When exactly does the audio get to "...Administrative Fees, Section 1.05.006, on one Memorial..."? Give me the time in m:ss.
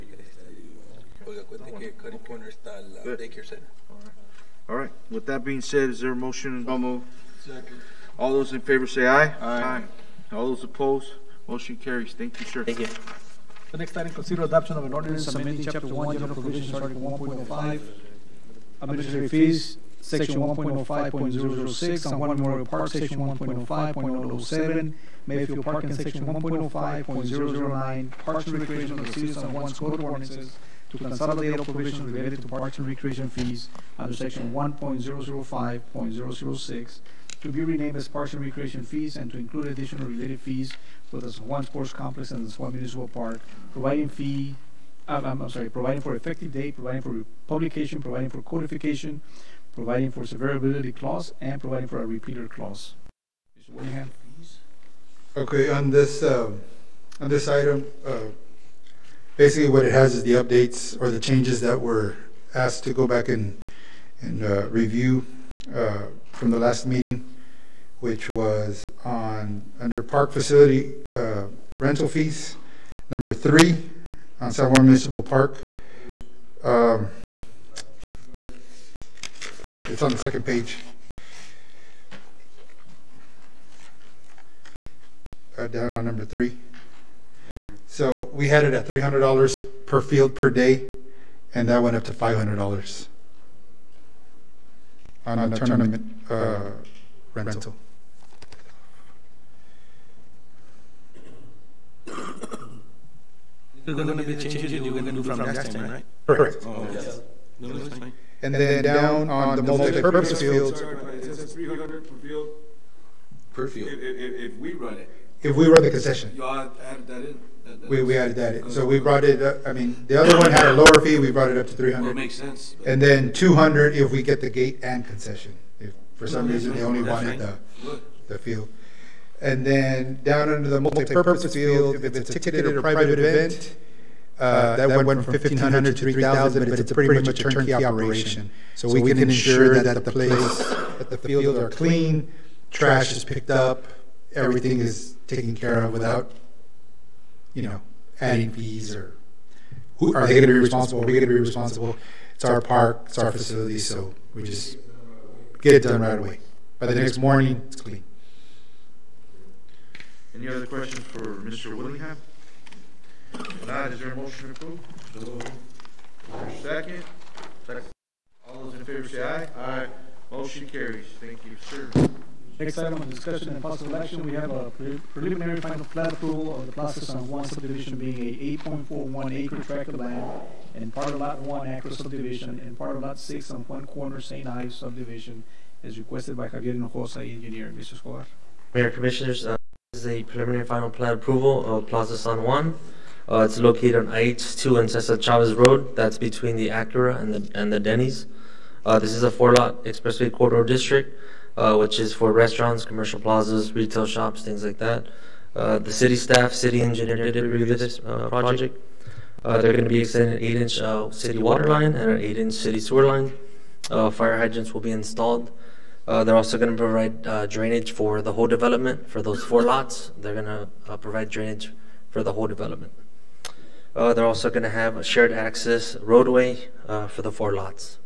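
0:18.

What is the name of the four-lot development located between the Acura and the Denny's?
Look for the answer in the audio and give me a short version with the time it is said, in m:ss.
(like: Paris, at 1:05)
Plaza San Juan, at 3:11.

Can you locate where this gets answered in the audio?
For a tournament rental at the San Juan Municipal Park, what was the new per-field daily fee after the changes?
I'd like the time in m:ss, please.
1:32.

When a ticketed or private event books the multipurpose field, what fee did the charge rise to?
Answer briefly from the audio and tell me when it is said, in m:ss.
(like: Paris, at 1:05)
$3,000, at 2:16.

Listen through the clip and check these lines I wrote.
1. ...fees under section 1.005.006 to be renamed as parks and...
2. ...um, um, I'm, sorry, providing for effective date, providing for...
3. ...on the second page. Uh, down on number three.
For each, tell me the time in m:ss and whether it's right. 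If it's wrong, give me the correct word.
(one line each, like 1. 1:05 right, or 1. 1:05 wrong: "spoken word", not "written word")
1. 0:33 right
2. 0:45 right
3. 1:20 right.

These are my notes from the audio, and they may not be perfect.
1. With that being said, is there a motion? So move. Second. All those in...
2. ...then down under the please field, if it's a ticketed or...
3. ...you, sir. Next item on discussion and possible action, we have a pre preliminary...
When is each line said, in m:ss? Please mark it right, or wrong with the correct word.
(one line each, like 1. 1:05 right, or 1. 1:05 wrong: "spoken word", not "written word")
1. 0:05 right
2. 2:09 wrong: "multipurpose", not "please"
3. 2:51 right.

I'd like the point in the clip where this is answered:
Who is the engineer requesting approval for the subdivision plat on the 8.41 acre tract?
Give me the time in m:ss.
3:06.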